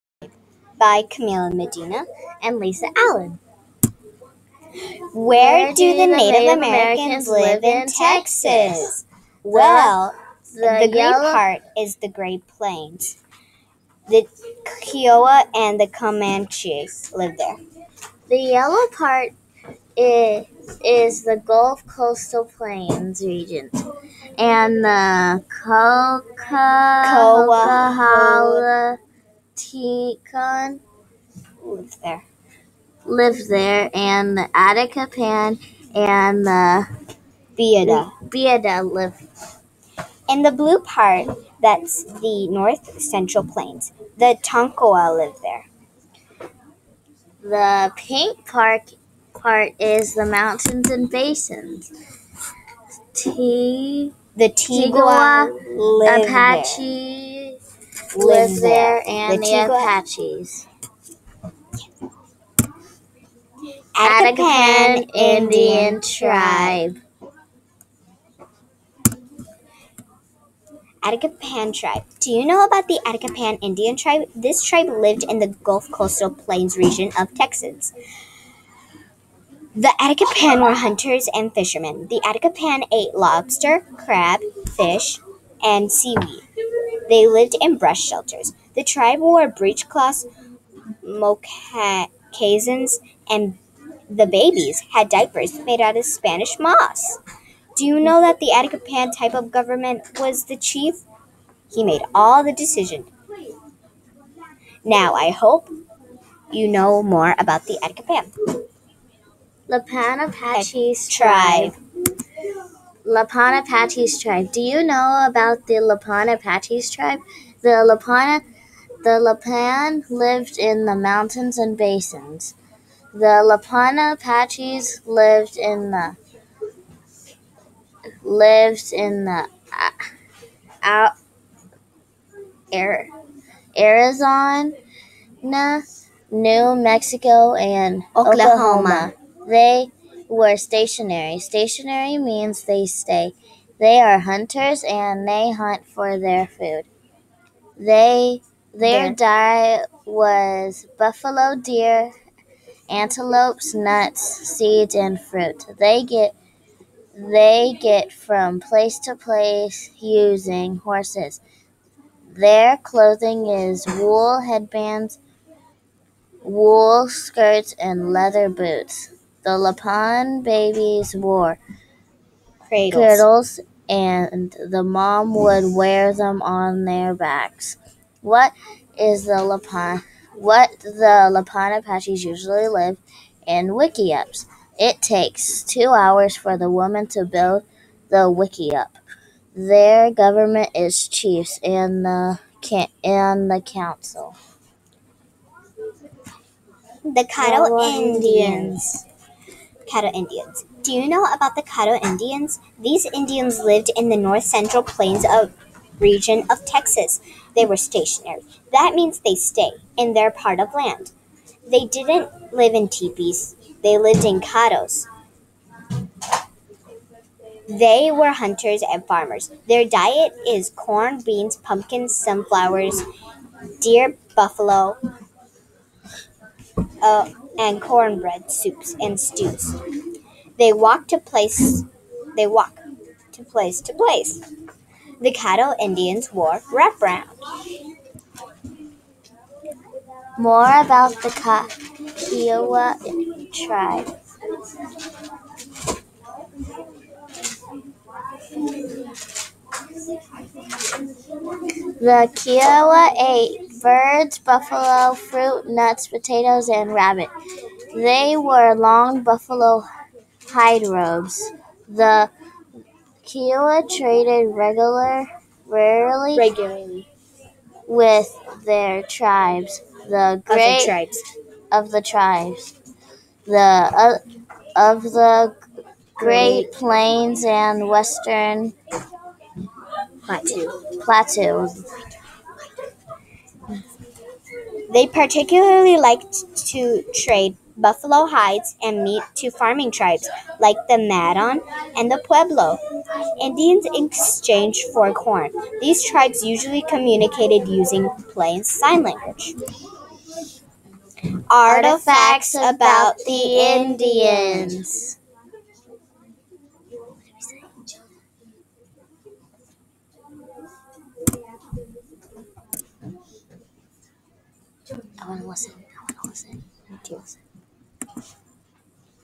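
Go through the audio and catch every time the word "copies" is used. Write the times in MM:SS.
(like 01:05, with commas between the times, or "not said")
not said.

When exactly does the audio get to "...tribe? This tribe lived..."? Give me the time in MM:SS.
01:13.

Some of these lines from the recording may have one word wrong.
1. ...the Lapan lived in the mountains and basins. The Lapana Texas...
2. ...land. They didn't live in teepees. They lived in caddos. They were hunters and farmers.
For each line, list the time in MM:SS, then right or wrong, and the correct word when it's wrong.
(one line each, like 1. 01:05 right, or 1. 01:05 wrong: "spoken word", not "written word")
1. 01:59 wrong: "Apaches", not "Texas"
2. 03:30 right.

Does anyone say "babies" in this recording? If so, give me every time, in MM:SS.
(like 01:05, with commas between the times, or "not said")
01:34, 02:50.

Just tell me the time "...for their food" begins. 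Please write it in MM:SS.
02:25.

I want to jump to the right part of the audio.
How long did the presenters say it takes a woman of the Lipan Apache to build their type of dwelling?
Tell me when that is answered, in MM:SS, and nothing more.
03:05.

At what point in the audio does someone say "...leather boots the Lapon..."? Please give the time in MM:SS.
02:48.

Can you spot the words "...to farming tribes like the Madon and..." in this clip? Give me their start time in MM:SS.
04:49.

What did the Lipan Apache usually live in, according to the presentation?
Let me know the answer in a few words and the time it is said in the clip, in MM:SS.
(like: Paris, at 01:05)
wickiups, at 03:03.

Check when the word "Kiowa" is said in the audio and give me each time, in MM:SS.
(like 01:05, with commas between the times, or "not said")
00:14, 04:01, 04:12, 04:23.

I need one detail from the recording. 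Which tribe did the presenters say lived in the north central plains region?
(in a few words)
Tonkawa.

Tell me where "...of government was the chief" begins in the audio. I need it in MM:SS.
01:39.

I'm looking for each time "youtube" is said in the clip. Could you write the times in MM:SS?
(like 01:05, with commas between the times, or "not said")
not said.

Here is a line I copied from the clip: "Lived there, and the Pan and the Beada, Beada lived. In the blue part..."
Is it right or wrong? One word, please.
right.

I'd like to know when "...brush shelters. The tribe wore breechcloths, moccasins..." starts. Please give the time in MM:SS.
01:27.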